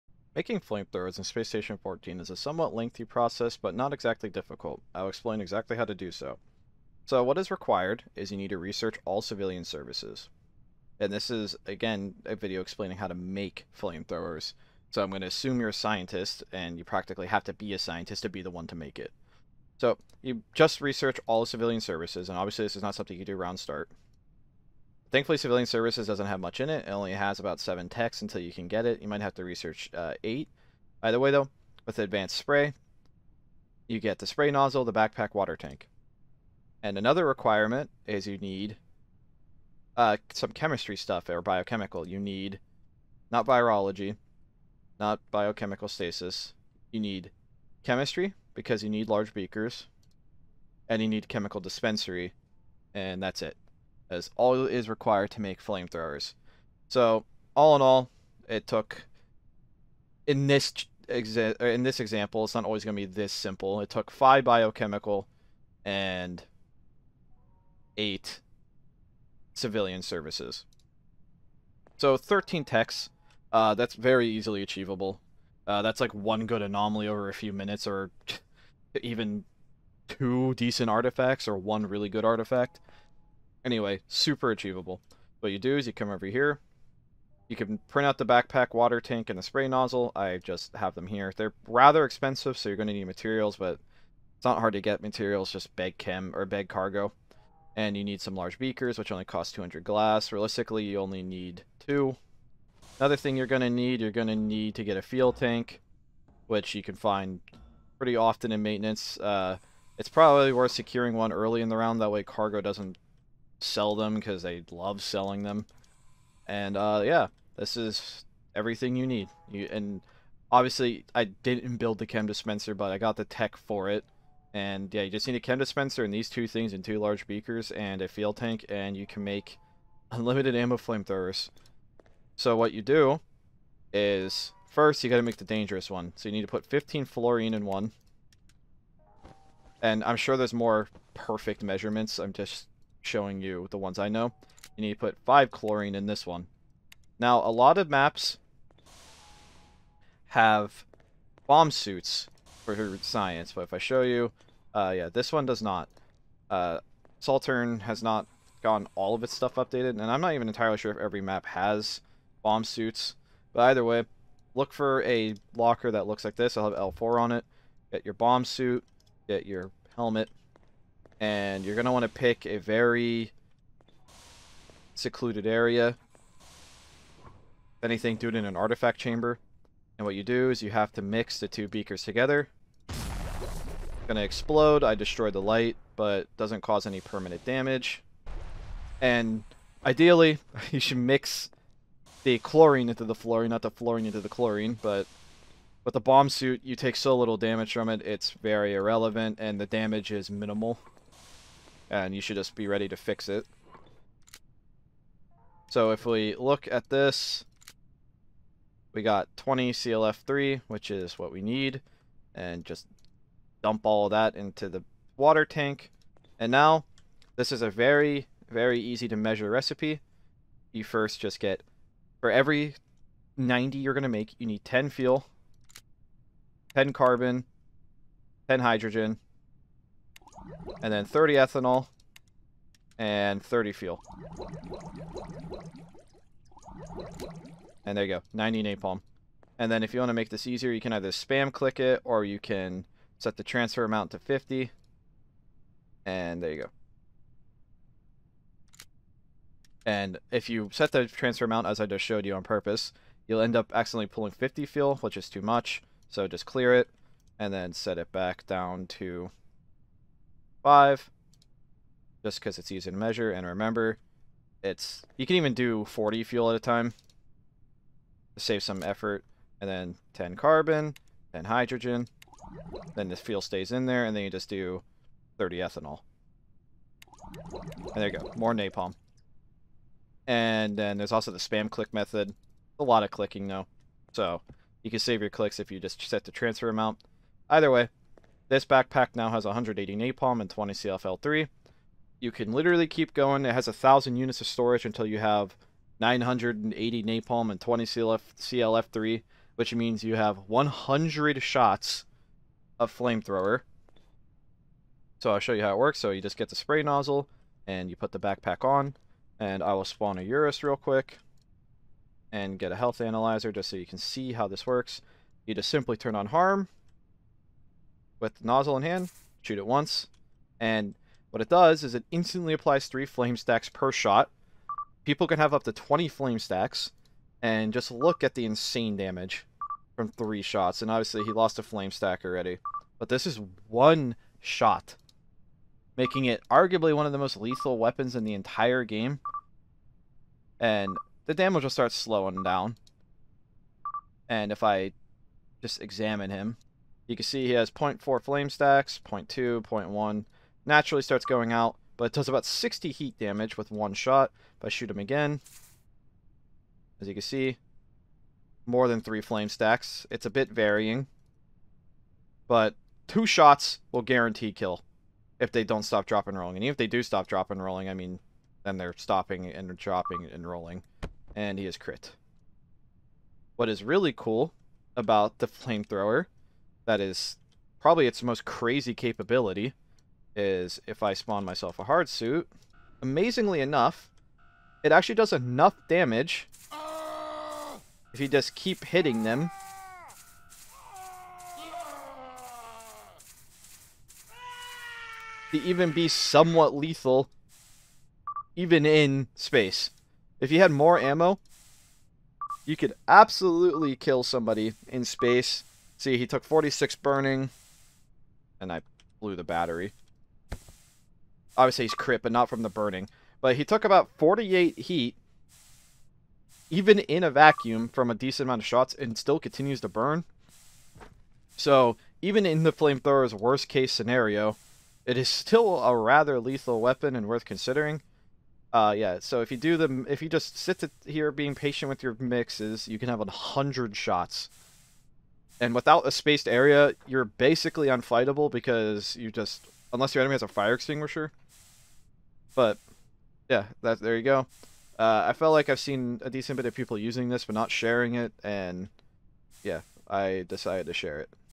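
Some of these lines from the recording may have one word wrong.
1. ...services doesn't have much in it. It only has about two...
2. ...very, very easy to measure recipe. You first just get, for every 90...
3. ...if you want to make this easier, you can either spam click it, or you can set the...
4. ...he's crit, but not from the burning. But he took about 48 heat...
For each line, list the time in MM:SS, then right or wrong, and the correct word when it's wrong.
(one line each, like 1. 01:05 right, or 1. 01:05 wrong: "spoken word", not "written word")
1. 00:25 wrong: "seven", not "two"
2. 03:37 right
3. 03:59 right
4. 06:51 right.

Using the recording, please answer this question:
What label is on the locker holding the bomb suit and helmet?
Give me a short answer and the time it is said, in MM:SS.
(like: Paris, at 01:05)
L4, at 02:46.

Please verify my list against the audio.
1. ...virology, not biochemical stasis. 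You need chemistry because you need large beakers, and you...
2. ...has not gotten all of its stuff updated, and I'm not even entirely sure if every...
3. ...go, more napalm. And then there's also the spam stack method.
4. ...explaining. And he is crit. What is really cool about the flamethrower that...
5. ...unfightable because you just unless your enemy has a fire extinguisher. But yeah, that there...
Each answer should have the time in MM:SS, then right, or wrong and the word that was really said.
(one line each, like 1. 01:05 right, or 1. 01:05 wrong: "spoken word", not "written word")
1. 00:43 right
2. 02:37 right
3. 04:38 wrong: "click", not "stack"
4. 06:10 wrong: "rolling", not "explaining"
5. 07:17 right.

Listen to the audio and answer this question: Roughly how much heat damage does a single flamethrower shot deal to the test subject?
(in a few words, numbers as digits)
60.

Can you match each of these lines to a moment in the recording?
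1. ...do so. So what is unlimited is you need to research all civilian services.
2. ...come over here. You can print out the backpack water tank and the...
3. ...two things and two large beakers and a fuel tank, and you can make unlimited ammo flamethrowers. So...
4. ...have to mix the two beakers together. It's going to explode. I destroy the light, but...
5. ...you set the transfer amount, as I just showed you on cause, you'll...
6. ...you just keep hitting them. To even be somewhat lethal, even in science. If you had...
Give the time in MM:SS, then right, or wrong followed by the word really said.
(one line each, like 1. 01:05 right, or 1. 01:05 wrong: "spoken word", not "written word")
1. 00:05 wrong: "required", not "unlimited"
2. 01:25 right
3. 02:06 right
4. 03:00 right
5. 04:10 wrong: "purpose", not "cause"
6. 06:28 wrong: "space", not "science".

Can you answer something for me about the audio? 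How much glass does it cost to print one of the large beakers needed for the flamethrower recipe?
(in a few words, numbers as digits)
200 glass.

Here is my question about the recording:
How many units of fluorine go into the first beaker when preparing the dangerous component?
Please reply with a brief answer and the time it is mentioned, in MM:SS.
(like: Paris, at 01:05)
15, at 02:16.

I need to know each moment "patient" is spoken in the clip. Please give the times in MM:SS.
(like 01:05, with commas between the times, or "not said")
07:11.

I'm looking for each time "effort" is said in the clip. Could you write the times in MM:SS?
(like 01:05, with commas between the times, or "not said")
04:28.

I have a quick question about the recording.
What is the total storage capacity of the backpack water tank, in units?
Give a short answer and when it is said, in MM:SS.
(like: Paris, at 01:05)
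1,000, at 04:53.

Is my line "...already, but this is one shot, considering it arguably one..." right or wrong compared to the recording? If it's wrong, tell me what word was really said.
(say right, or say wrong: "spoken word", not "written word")
wrong: "making", not "considering".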